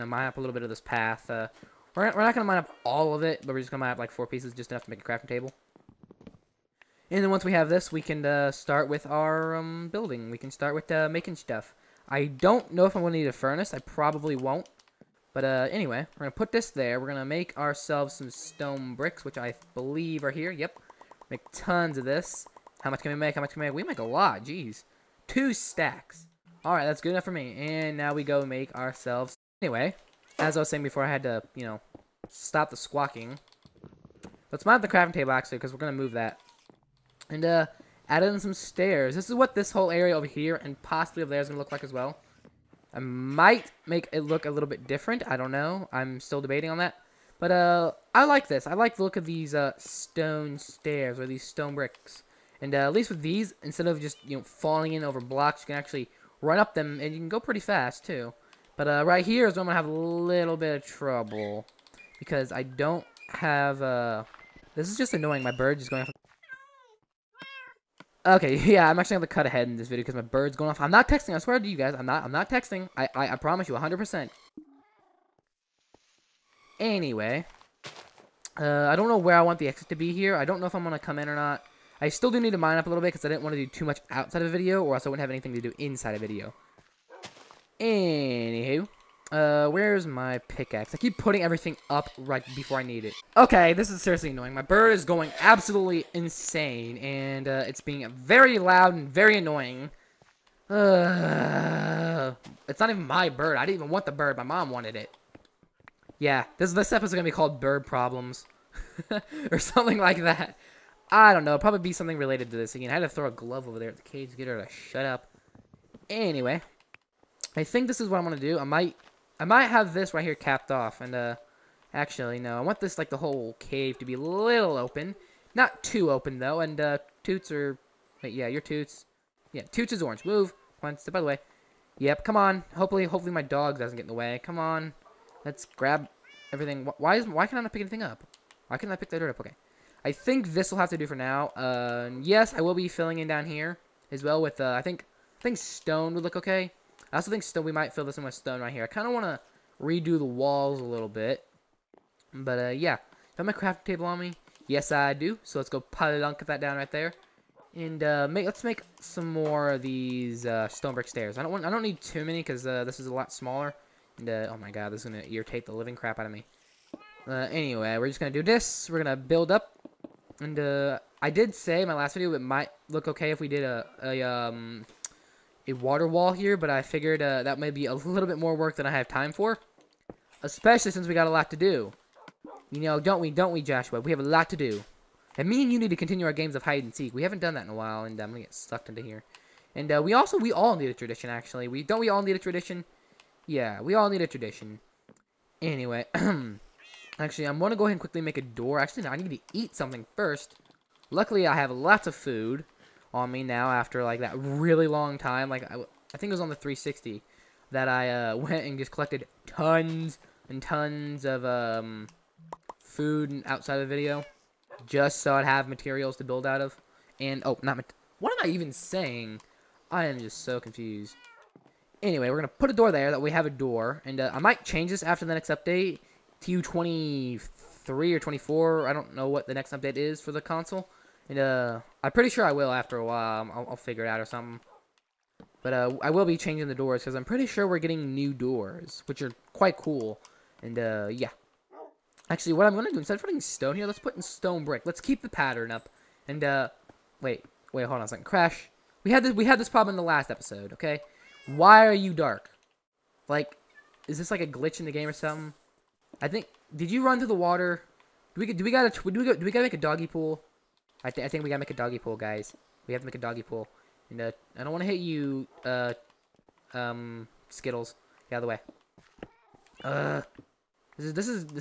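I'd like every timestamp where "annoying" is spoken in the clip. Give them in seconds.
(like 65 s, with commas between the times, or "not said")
65 s, 94 s, 99 s.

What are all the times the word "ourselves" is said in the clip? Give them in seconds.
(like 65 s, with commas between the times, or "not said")
17 s, 28 s.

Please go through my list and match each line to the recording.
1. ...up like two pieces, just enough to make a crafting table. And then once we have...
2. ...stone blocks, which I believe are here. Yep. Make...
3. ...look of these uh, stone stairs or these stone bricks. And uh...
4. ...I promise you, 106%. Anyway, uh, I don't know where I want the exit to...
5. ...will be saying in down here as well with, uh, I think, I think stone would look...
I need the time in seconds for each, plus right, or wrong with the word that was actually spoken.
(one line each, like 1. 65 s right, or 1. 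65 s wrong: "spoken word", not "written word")
1. 3 s wrong: "four", not "two"
2. 18 s wrong: "bricks", not "blocks"
3. 49 s right
4. 73 s wrong: "100", not "106"
5. 142 s wrong: "filling", not "saying".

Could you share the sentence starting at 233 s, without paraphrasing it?
I'll, I'll figure it out or something.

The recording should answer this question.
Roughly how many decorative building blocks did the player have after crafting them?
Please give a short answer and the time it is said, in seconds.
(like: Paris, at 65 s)
2 stacks, at 25 s.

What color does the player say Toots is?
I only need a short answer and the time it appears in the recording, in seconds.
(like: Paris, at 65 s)
Orange, at 130 s.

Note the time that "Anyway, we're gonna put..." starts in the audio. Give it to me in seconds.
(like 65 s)
222 s.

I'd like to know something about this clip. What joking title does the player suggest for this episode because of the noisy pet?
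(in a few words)
Bird Problems.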